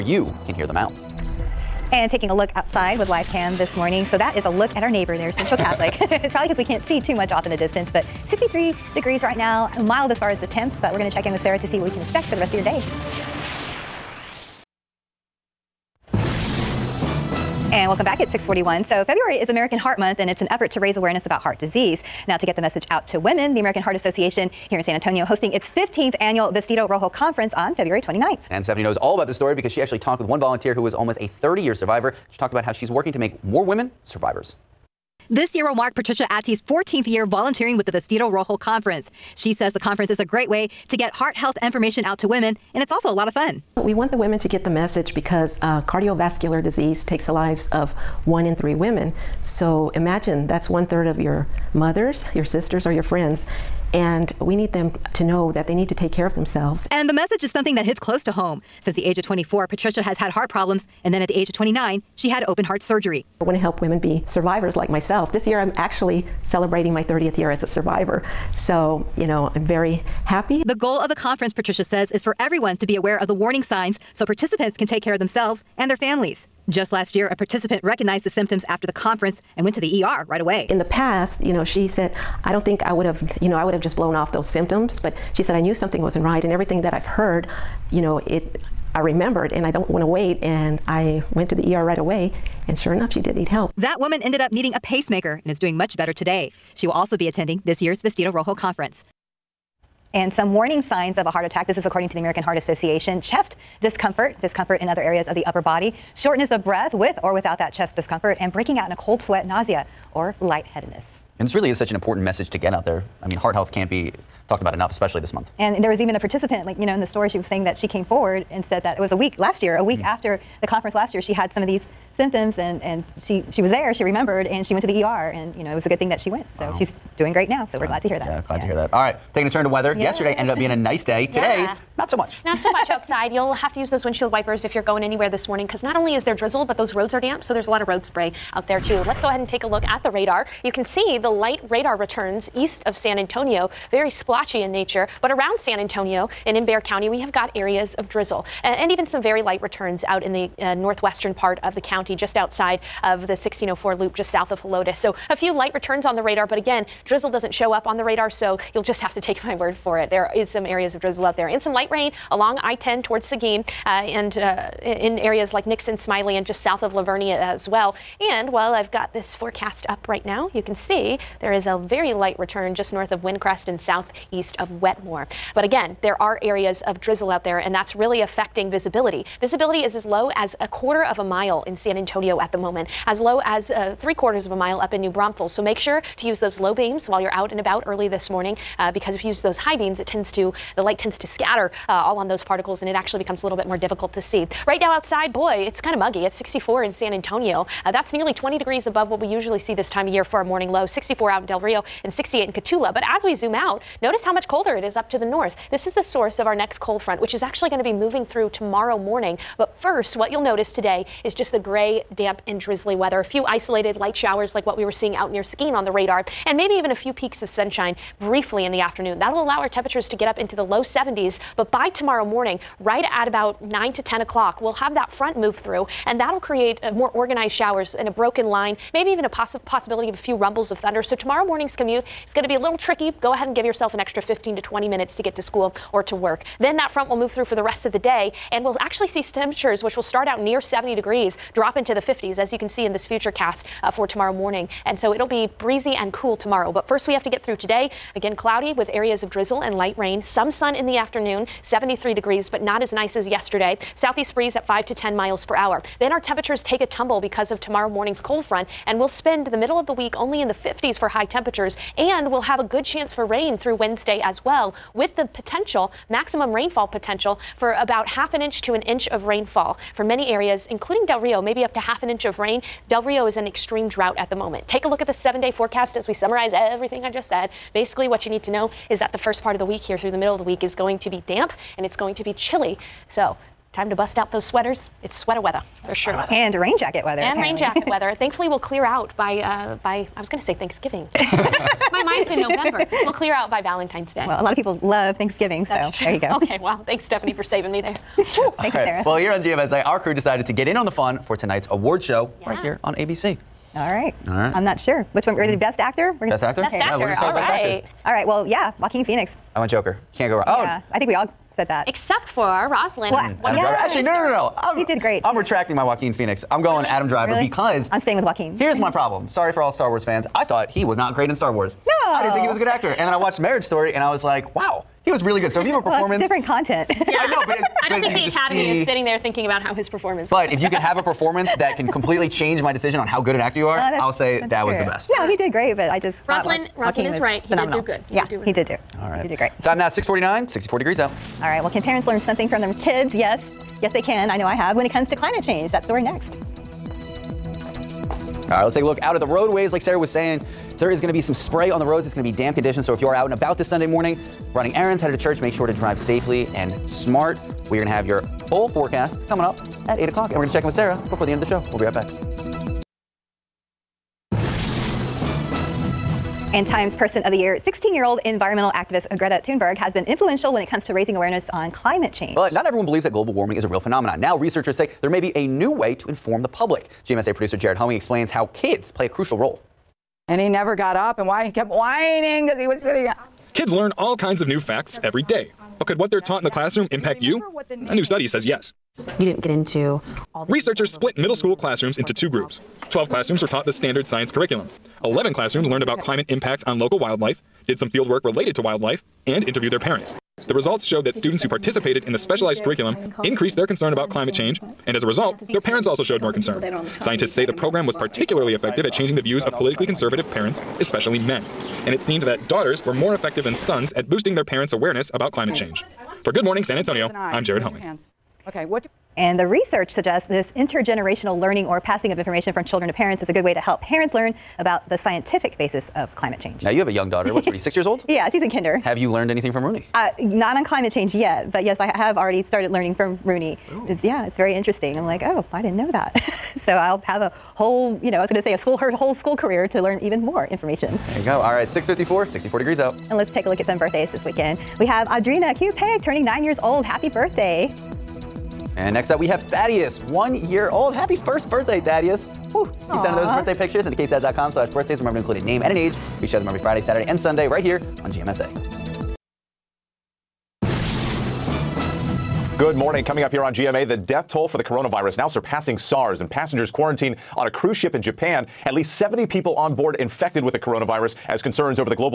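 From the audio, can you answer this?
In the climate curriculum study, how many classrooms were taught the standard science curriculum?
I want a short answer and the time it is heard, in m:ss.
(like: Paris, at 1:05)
12, at 6:32.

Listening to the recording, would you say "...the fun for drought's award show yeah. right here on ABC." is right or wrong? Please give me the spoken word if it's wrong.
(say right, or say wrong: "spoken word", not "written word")
wrong: "tonight", not "drought".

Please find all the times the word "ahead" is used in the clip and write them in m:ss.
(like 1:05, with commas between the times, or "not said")
2:19, 3:53.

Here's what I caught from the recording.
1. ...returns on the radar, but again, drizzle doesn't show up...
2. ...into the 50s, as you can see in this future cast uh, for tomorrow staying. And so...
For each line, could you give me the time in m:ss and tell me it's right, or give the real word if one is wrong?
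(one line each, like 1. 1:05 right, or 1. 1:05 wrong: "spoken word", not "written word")
1. 2:35 right
2. 4:01 wrong: "morning", not "staying".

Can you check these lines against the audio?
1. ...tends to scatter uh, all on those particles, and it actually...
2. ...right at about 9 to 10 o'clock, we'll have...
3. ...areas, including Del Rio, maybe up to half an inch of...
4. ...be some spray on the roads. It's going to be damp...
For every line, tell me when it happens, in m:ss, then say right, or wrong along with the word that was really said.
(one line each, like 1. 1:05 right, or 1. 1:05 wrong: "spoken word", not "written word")
1. 3:10 right
2. 3:42 right
3. 4:30 right
4. 5:51 right.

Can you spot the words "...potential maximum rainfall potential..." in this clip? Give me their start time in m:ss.
4:25.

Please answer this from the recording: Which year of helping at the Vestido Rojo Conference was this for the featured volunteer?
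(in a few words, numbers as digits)
14th year.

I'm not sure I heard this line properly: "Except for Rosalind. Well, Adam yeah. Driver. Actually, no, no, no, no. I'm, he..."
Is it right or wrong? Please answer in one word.
right.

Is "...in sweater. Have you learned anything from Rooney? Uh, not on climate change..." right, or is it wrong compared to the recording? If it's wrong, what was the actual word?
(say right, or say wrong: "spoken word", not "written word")
wrong: "kinder", not "sweater".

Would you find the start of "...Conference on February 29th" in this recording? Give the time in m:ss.
0:27.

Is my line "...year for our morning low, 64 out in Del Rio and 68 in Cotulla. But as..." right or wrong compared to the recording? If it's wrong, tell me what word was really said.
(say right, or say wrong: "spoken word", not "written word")
right.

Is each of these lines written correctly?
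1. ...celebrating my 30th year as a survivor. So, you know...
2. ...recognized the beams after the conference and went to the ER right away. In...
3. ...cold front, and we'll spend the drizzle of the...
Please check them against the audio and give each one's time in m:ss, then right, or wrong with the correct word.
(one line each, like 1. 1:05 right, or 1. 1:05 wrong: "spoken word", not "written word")
1. 1:06 right
2. 1:17 wrong: "symptoms", not "beams"
3. 4:18 wrong: "middle", not "drizzle".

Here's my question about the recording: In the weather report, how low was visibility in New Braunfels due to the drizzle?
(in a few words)
3/4 of a mile.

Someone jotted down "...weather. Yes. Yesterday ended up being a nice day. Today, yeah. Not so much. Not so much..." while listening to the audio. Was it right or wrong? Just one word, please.
right.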